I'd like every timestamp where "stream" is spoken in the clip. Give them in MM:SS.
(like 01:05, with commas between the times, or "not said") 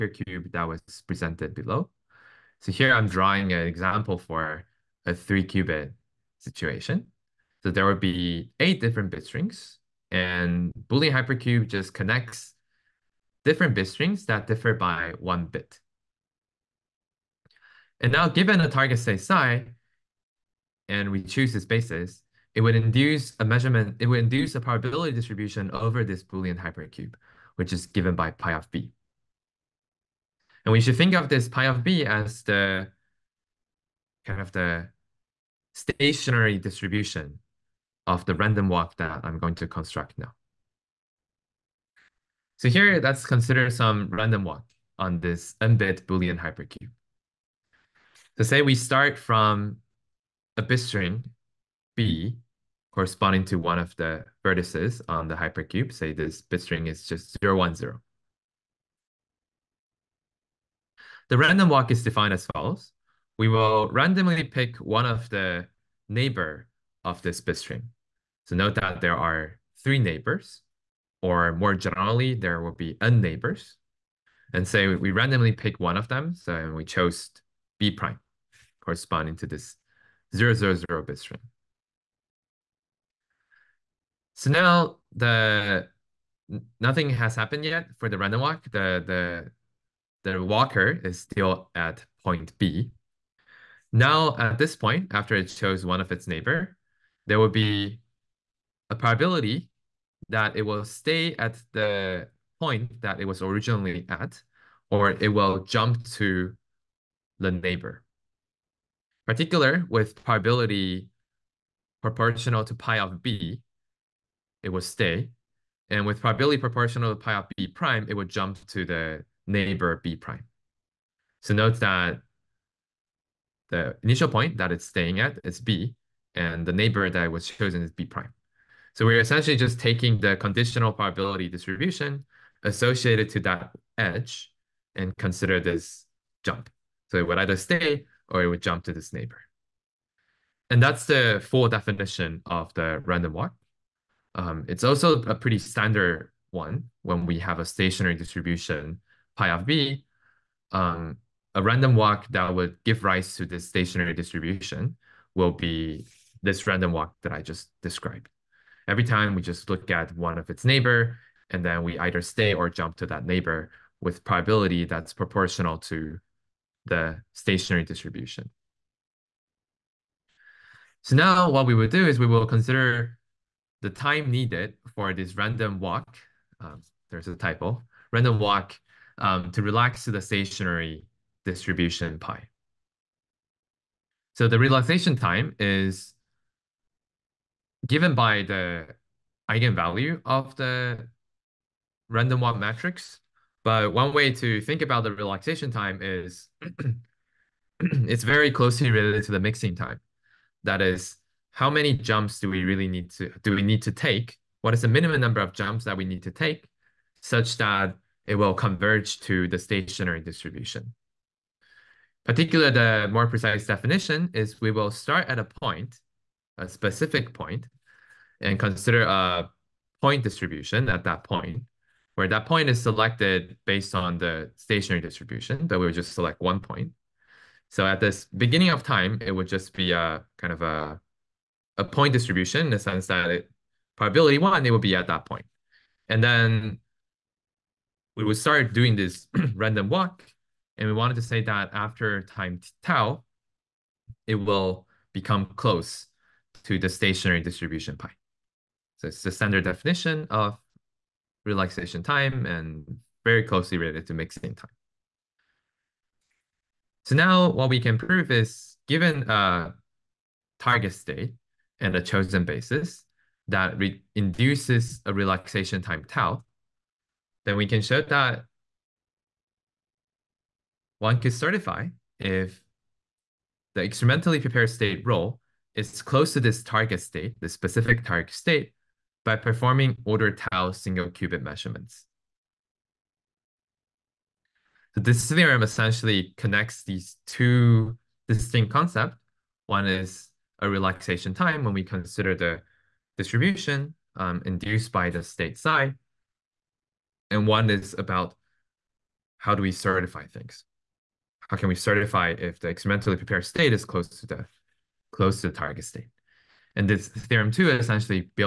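not said.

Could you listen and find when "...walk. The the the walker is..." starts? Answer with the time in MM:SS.
01:28.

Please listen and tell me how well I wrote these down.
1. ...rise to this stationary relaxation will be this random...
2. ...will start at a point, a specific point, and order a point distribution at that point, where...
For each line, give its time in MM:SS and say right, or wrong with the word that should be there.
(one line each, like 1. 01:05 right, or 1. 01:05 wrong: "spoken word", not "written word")
1. 02:33 wrong: "distribution", not "relaxation"
2. 03:34 wrong: "consider", not "order".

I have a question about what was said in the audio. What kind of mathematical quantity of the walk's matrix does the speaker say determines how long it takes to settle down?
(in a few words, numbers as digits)
eigenvalue.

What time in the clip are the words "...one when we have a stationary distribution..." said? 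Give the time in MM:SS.
02:26.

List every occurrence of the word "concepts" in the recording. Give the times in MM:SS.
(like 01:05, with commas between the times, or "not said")
04:48.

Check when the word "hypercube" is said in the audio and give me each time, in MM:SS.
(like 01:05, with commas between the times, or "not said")
00:11, 00:26, 00:46, 00:55.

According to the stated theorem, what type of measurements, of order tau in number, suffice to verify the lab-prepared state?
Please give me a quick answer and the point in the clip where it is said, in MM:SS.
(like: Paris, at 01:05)
single qubit measurements, at 04:40.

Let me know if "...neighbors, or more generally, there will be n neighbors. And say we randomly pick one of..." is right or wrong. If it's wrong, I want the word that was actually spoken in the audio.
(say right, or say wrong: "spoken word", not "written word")
right.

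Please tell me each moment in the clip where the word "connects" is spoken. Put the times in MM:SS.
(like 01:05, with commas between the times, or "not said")
00:11, 04:46.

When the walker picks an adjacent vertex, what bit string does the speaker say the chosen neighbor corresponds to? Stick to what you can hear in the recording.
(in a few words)
000.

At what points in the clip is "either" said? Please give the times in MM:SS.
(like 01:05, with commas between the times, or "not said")
02:17, 02:41.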